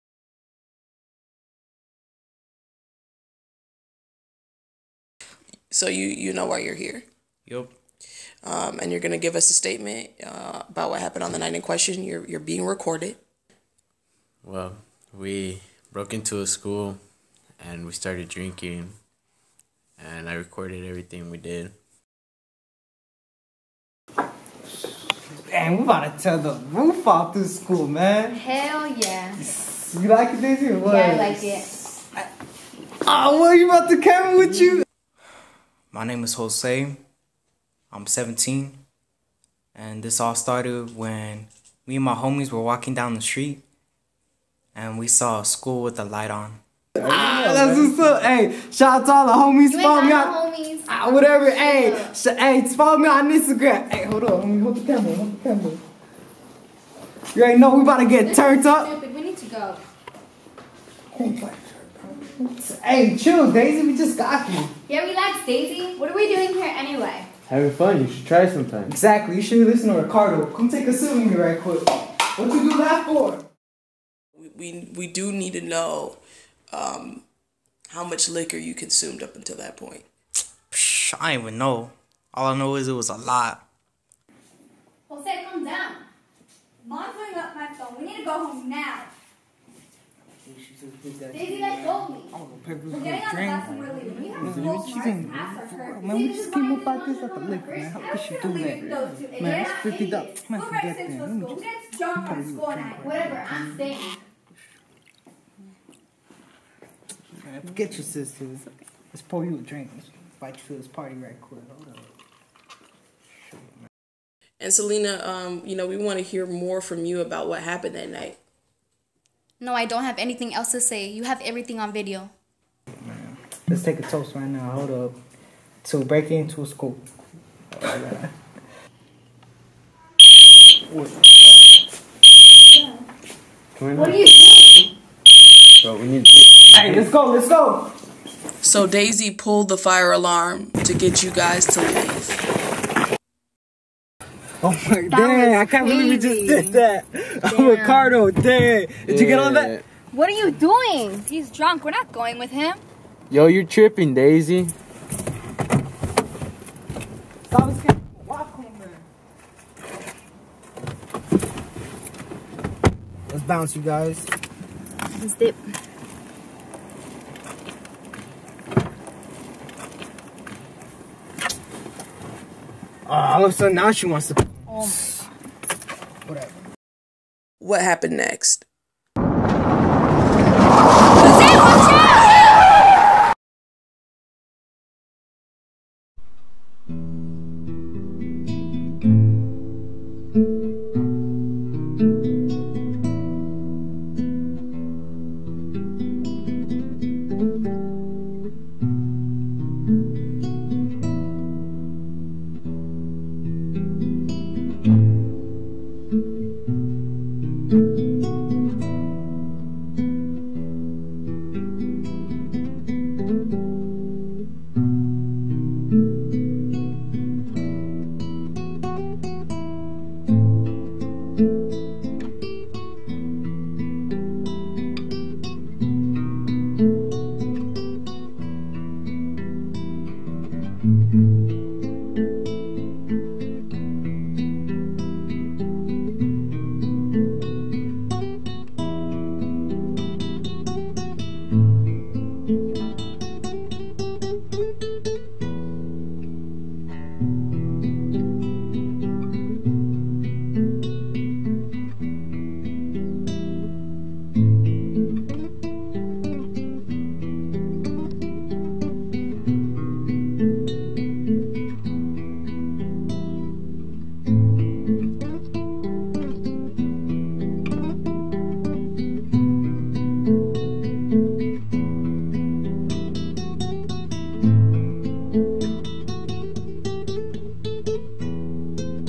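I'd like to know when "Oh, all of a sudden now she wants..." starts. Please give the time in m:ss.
2:53.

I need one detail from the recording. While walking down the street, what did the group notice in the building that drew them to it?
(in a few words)
A light on.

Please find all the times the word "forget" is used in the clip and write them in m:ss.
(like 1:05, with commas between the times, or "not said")
1:40, 1:47.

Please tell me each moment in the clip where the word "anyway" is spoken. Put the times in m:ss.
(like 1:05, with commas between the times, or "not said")
1:06.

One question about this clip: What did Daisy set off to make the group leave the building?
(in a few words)
The fire alarm.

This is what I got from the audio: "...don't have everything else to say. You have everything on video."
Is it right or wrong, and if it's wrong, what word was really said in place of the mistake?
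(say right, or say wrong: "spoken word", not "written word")
wrong: "anything", not "everything".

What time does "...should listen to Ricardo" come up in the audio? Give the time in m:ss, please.
1:09.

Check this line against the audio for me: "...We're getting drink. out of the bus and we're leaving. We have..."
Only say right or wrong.
right.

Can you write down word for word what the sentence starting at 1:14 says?
We, we, we do need to know um, how much liquor you consumed up until that point.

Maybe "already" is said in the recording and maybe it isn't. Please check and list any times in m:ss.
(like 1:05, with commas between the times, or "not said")
0:57.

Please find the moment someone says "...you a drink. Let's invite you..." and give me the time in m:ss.
1:49.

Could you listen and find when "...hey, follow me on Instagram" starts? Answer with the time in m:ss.
0:52.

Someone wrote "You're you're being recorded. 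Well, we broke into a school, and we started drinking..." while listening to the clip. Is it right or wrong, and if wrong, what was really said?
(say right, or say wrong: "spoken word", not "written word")
right.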